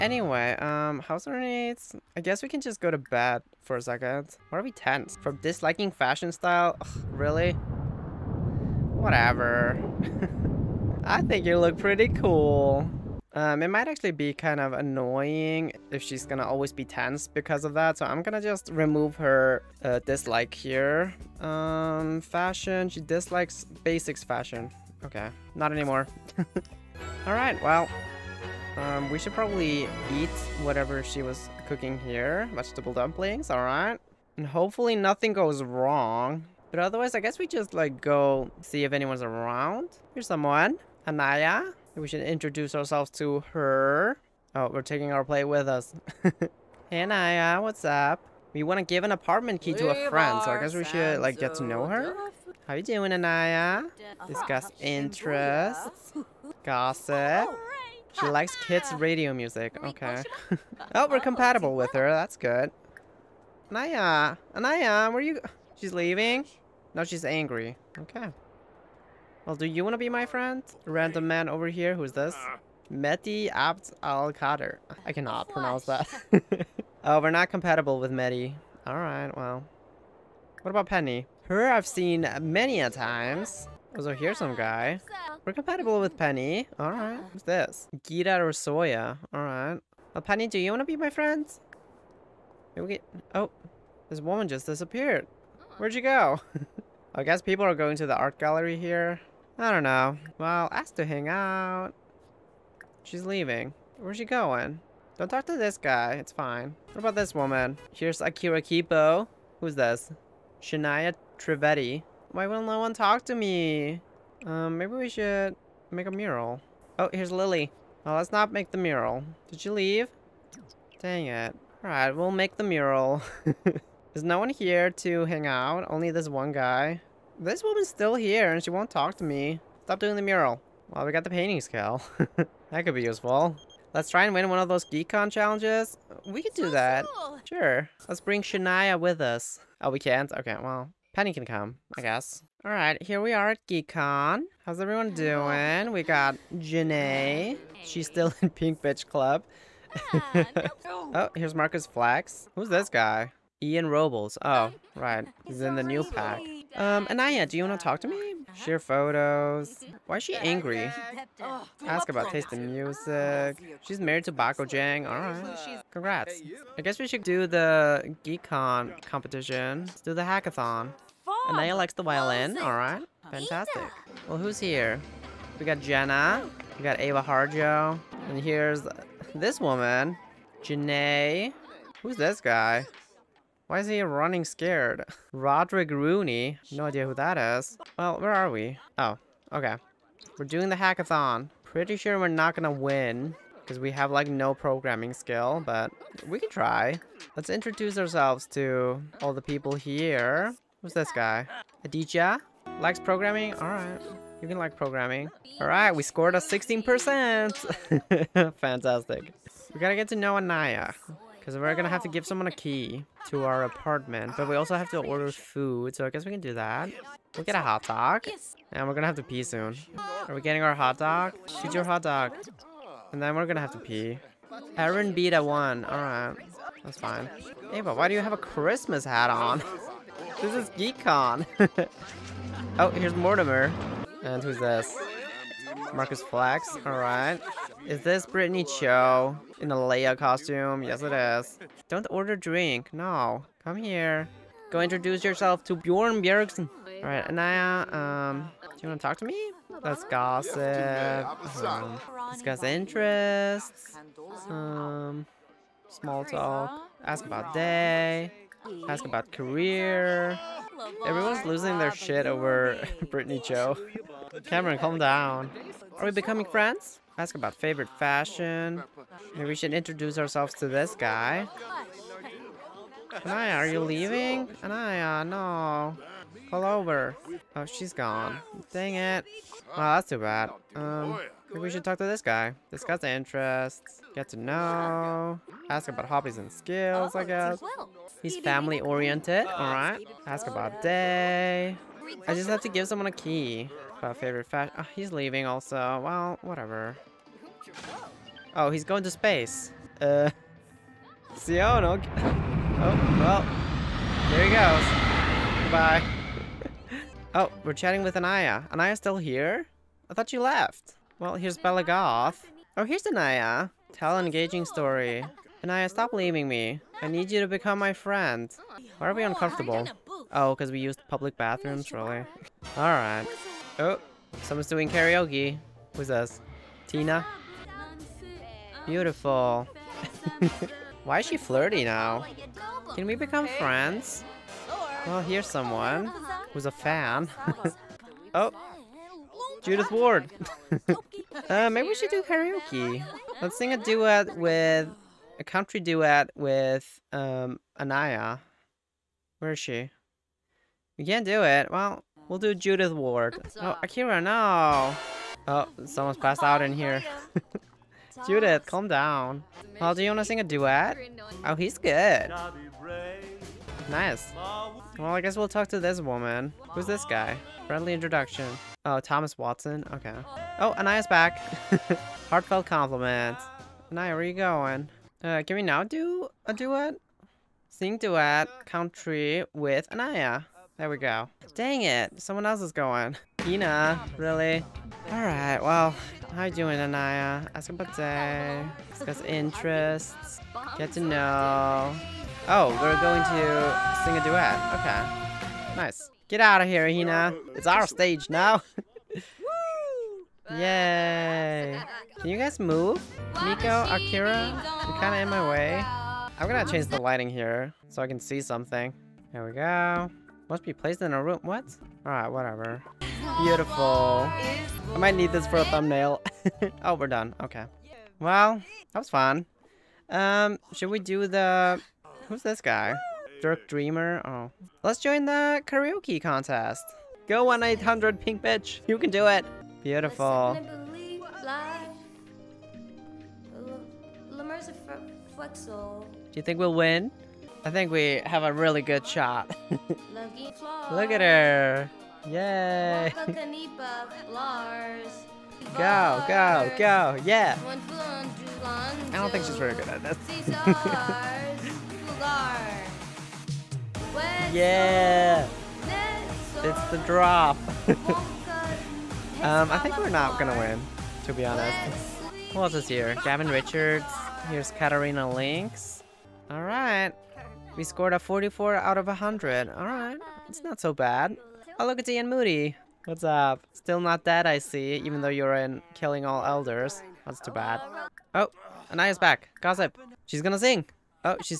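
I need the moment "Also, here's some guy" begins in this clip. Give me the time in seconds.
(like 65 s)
83 s.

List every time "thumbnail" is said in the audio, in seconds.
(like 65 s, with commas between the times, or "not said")
415 s.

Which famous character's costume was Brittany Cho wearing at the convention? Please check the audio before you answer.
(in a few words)
Leia.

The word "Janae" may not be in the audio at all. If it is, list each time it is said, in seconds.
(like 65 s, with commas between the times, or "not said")
146 s, 180 s.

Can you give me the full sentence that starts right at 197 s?
Let's introduce ourselves to all the people here.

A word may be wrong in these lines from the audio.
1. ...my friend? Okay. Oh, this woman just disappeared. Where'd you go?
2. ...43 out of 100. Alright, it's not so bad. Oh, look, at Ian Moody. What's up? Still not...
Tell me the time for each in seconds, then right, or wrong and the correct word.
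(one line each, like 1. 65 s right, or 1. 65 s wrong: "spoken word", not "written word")
1. 90 s right
2. 468 s wrong: "44", not "43".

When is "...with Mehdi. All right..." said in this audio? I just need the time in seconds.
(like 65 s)
77 s.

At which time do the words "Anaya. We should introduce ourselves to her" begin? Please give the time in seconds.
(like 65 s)
41 s.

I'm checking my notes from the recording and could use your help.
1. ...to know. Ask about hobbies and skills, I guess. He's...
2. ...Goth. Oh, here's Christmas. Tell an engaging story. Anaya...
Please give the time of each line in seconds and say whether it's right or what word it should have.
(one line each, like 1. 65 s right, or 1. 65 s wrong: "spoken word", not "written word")
1. 284 s right
2. 311 s wrong: "Anaya", not "Christmas".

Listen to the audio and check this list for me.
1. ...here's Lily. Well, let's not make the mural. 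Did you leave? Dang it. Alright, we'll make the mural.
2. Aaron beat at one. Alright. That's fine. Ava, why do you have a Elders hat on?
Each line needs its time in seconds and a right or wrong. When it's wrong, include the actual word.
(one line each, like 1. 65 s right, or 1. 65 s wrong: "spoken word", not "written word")
1. 117 s right
2. 224 s wrong: "Christmas", not "Elders".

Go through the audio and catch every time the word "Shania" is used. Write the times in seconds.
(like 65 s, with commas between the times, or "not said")
110 s, 138 s.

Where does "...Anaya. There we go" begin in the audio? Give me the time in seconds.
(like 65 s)
379 s.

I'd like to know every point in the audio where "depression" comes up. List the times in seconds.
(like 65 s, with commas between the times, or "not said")
not said.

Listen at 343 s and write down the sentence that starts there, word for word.
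Let's sing a duet with a country duet with um, Anaya.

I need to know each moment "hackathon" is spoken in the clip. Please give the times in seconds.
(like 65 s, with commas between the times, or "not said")
170 s, 190 s.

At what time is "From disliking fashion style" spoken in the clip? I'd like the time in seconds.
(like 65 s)
5 s.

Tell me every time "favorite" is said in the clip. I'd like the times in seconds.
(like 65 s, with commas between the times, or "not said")
267 s, 294 s.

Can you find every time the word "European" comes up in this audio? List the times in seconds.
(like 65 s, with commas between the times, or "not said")
not said.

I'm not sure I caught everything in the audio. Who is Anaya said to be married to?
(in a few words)
Bako Jang.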